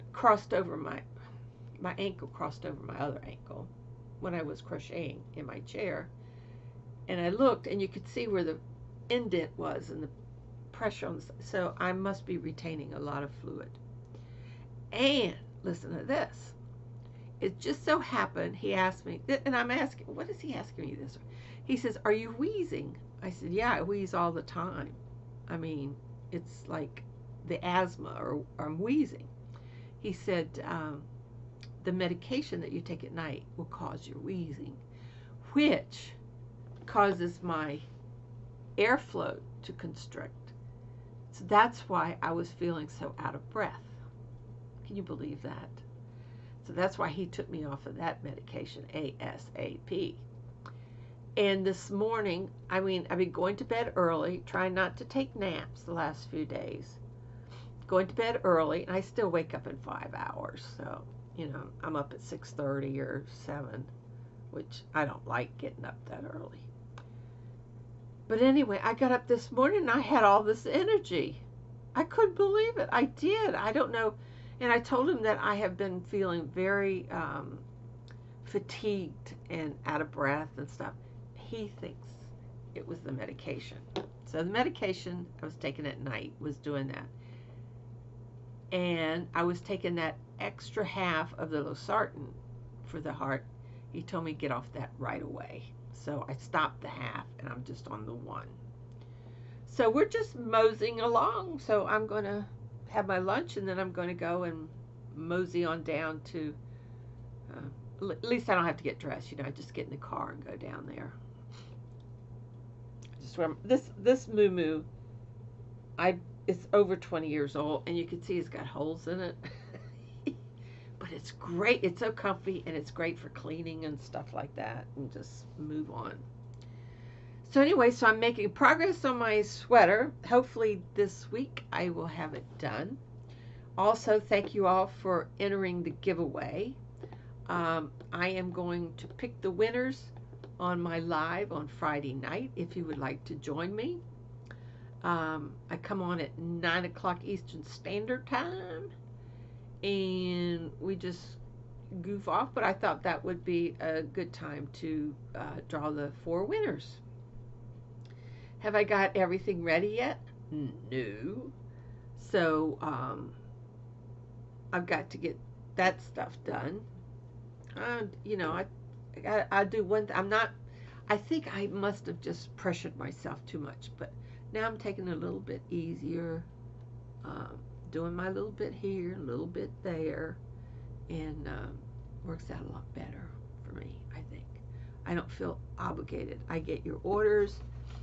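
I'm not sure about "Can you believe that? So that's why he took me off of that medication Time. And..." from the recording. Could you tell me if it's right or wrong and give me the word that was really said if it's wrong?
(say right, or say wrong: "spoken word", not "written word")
wrong: "ASAP", not "Time".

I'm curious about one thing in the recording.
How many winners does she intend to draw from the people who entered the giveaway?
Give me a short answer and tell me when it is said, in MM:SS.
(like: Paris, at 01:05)
4, at 02:36.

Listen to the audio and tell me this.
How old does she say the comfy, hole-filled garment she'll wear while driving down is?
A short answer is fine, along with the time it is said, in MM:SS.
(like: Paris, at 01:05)
over 20 years, at 01:56.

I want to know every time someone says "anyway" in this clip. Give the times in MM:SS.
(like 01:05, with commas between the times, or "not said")
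01:08, 02:07.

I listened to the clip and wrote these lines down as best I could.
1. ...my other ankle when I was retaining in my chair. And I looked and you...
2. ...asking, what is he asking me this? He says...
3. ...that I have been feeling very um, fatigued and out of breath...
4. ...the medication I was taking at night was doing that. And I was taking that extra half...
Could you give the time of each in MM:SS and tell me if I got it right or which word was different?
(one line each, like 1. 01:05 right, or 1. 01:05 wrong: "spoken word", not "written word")
1. 00:02 wrong: "crocheting", not "retaining"
2. 00:19 right
3. 01:15 right
4. 01:24 right.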